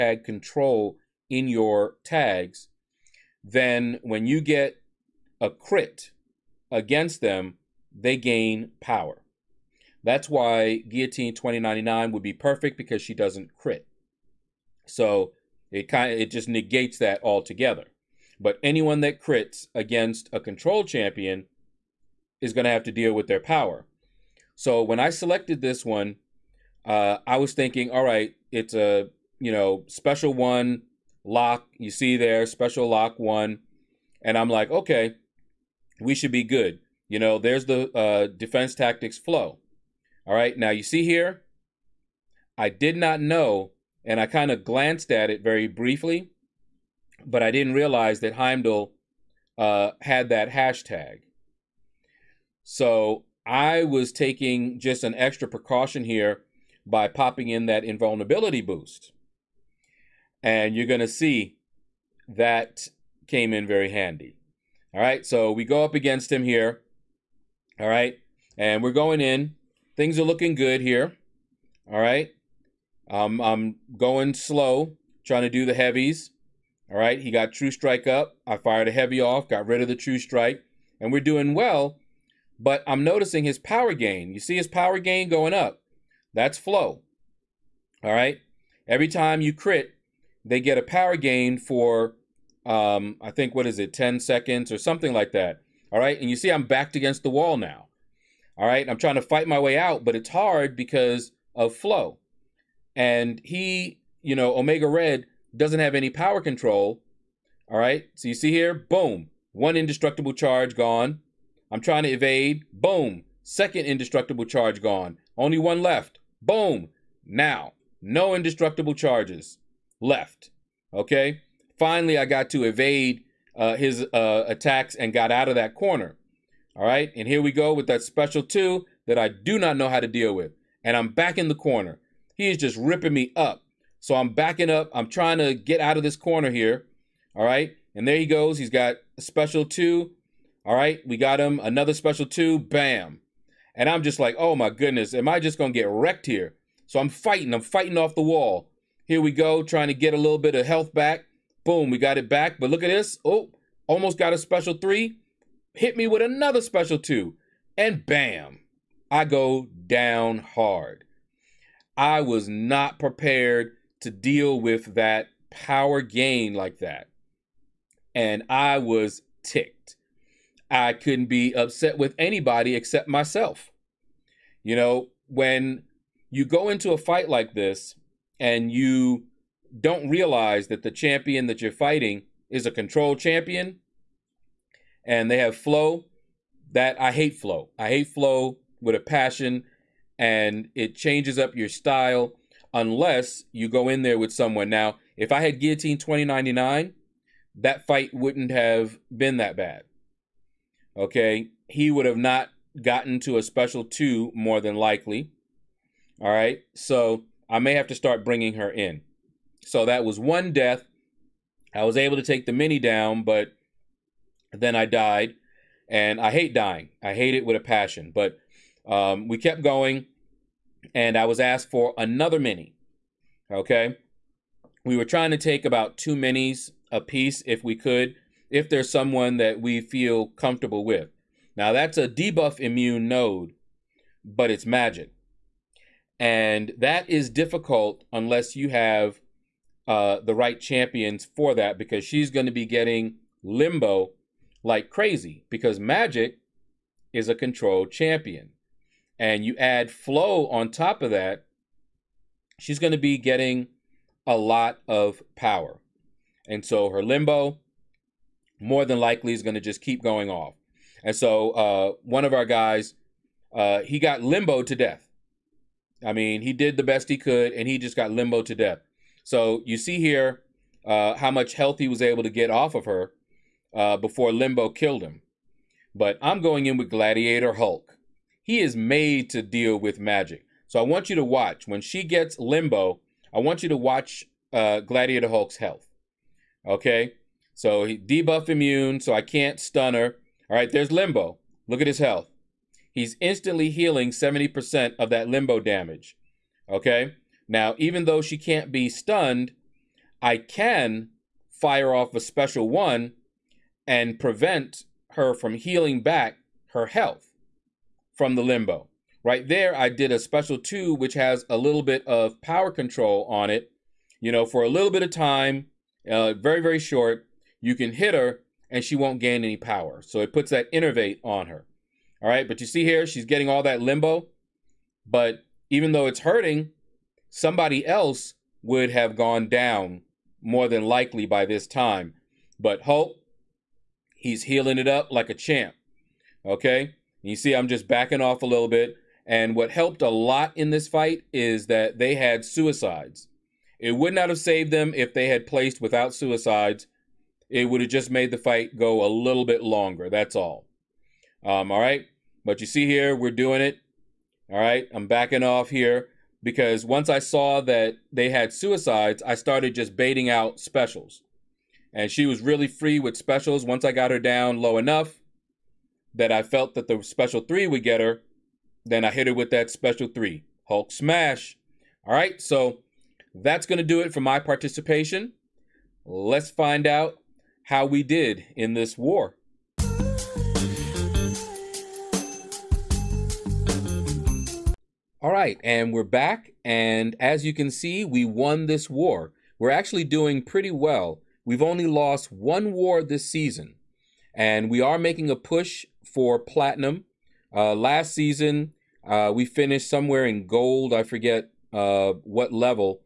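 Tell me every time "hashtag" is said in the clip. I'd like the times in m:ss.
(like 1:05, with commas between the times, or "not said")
0:50.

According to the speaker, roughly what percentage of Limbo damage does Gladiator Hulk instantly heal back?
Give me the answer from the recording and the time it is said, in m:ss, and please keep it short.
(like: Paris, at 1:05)
70%, at 4:54.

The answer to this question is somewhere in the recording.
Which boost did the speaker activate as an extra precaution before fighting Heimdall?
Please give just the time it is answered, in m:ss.
0:57.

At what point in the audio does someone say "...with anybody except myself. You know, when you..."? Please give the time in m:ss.
2:51.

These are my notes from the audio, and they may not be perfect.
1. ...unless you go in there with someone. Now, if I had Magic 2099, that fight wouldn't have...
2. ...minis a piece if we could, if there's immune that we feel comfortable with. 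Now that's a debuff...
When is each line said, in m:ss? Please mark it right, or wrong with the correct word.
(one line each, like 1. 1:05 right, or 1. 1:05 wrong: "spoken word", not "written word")
1. 3:12 wrong: "Guillotine", not "Magic"
2. 3:46 wrong: "someone", not "immune".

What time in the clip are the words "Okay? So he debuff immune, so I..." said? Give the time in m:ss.
4:46.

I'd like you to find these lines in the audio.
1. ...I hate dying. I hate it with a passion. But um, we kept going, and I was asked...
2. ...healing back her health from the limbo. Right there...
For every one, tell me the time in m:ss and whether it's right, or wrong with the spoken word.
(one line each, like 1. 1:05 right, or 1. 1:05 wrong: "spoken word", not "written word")
1. 3:36 right
2. 5:05 right.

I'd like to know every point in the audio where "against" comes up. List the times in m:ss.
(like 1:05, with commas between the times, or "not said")
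0:06, 0:19, 1:05, 1:36.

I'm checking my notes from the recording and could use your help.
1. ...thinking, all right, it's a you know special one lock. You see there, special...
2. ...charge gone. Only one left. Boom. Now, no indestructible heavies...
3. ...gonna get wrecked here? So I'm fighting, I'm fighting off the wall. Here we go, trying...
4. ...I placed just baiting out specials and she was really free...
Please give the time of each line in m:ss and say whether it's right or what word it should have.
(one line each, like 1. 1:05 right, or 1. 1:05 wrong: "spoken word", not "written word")
1. 0:27 right
2. 1:54 wrong: "charges", not "heavies"
3. 2:25 right
4. 5:59 wrong: "started", not "placed".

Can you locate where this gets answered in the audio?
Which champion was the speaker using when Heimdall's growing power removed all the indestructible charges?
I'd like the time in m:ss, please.
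1:44.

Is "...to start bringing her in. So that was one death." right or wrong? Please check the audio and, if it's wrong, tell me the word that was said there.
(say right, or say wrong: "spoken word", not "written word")
right.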